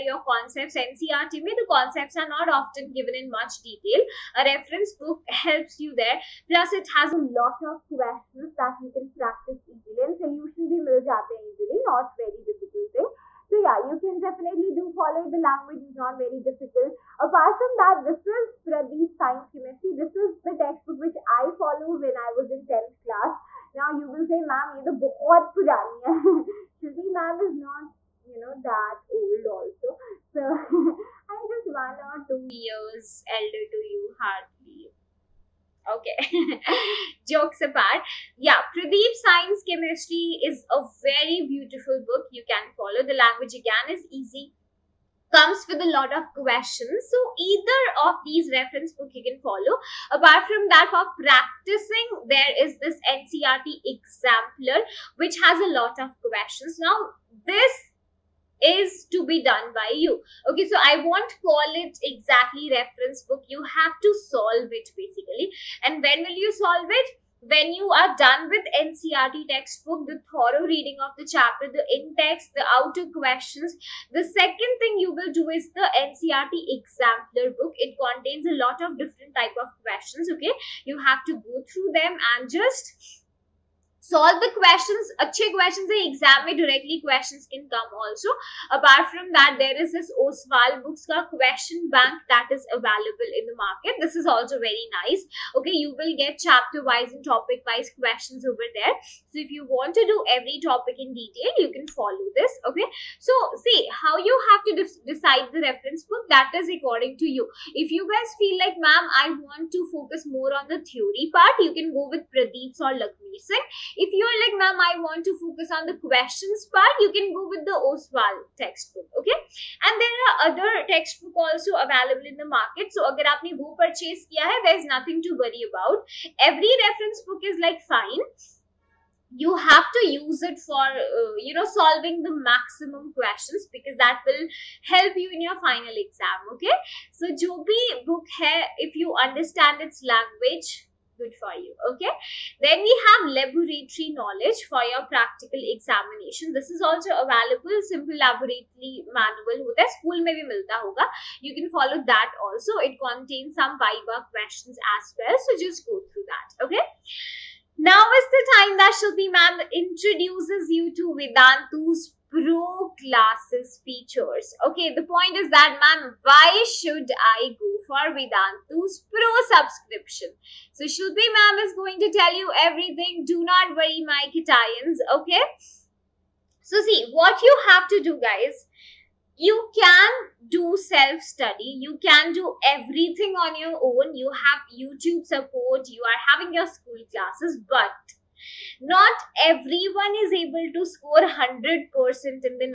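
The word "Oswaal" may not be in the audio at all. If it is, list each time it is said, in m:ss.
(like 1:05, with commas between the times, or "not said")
1:30, 1:57.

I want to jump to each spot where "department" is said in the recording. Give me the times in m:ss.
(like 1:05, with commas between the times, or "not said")
not said.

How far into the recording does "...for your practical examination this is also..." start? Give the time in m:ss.
2:24.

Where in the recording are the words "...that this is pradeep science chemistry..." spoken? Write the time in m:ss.
0:17.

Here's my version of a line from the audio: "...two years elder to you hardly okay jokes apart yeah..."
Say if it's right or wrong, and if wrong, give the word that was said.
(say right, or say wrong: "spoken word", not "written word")
right.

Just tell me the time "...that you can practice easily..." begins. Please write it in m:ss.
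0:08.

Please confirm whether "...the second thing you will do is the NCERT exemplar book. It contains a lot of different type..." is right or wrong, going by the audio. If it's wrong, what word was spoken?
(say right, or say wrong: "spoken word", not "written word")
right.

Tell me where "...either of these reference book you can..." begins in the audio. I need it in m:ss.
0:47.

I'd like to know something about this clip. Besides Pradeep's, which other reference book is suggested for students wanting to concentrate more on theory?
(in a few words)
Lakhmir Singh.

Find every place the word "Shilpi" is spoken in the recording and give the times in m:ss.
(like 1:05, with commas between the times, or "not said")
0:26, 2:50.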